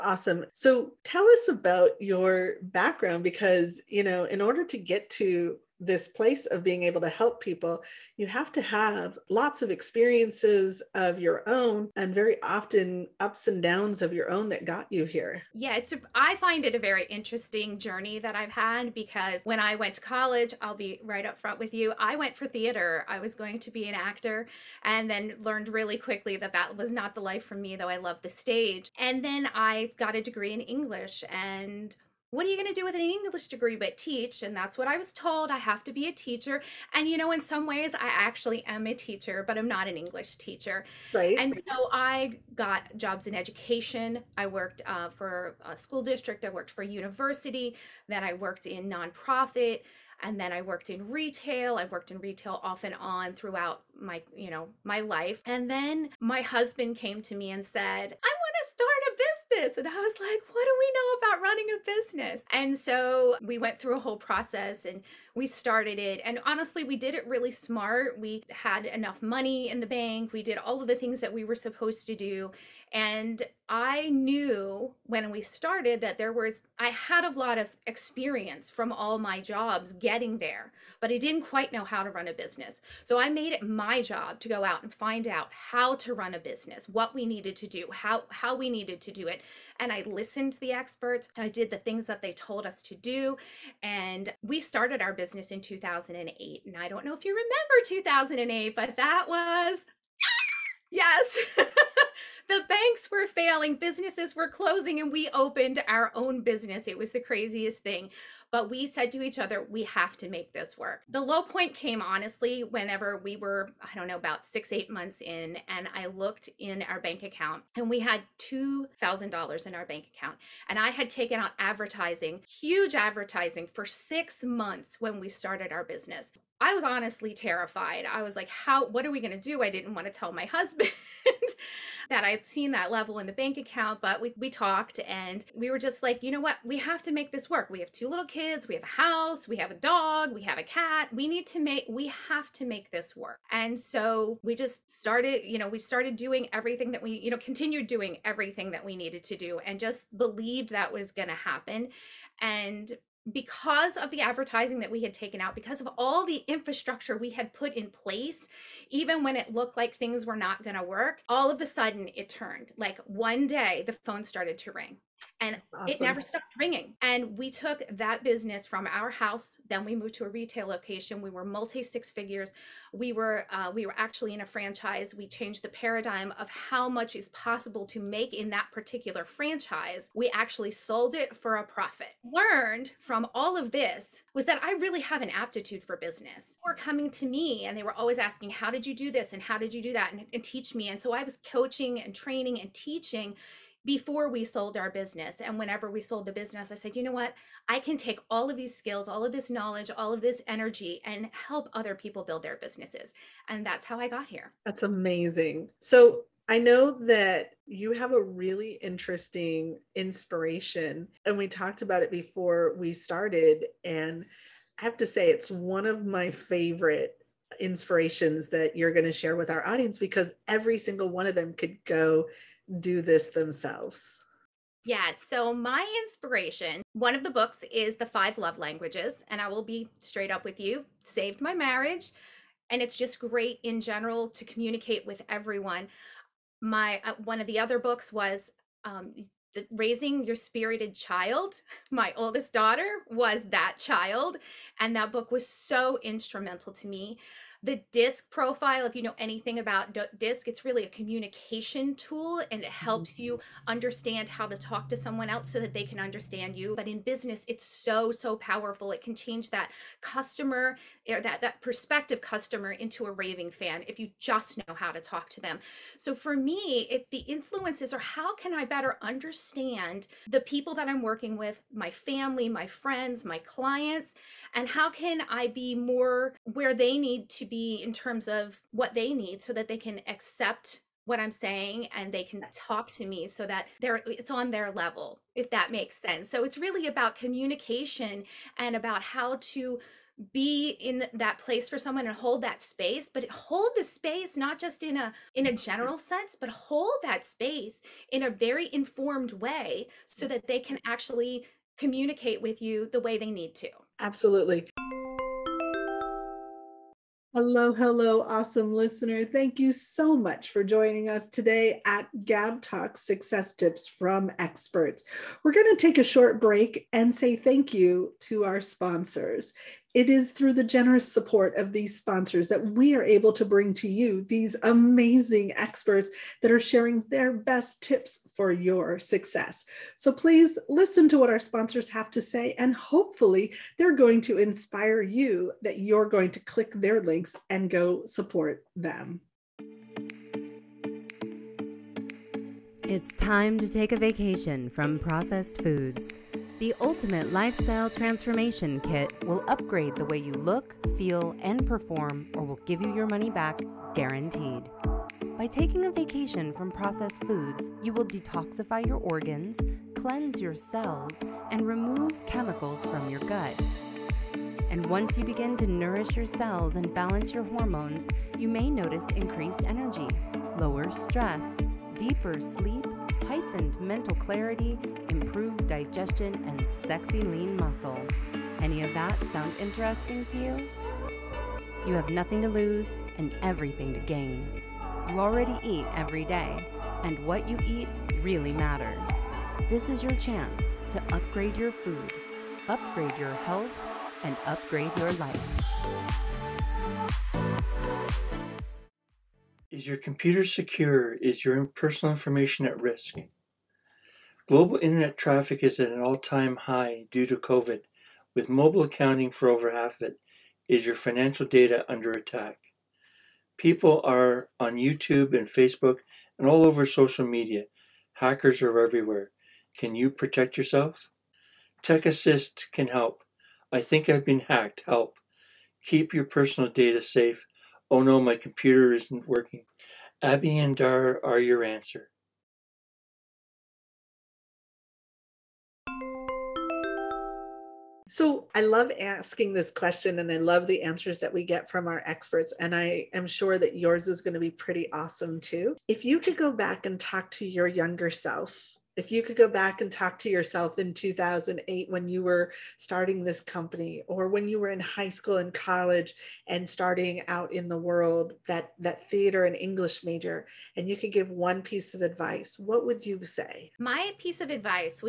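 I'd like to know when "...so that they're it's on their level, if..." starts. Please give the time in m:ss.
4:43.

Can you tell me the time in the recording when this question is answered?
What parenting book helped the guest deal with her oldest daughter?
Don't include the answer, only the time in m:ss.
3:59.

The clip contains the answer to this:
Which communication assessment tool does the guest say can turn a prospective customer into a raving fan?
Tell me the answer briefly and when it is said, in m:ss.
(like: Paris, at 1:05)
DISC profile, at 4:07.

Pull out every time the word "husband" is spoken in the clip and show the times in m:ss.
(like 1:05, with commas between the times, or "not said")
0:56, 2:10.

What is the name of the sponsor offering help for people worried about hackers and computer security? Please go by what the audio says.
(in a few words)
Tech Assist.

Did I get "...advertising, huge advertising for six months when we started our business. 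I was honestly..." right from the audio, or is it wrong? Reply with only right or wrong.
right.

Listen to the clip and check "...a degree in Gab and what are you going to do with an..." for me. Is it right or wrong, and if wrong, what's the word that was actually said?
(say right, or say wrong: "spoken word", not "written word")
wrong: "English", not "Gab".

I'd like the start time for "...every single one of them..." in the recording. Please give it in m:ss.
3:40.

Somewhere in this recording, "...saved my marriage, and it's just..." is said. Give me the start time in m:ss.
3:51.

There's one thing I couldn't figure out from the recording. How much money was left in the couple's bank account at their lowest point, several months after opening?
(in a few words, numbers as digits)
$2,000.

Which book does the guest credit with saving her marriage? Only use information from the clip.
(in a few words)
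The Five Love Languages.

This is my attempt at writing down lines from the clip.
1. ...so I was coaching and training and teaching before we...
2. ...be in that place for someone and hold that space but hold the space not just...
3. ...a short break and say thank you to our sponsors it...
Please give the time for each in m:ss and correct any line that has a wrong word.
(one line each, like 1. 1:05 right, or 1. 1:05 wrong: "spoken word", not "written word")
1. 3:10 right
2. 4:50 right
3. 5:15 right.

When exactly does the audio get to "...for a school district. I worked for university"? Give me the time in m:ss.
0:45.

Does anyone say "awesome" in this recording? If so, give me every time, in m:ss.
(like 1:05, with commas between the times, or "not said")
2:45, 5:08, 7:24.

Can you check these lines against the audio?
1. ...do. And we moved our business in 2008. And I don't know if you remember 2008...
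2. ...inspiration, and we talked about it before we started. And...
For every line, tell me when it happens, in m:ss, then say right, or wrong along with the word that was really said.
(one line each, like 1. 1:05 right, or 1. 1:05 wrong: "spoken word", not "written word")
1. 1:32 wrong: "started", not "moved"
2. 3:29 right.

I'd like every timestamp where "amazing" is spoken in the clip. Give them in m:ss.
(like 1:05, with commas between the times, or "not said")
3:24, 5:24.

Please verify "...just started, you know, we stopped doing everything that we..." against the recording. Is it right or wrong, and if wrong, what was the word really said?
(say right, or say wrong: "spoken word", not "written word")
wrong: "started", not "stopped".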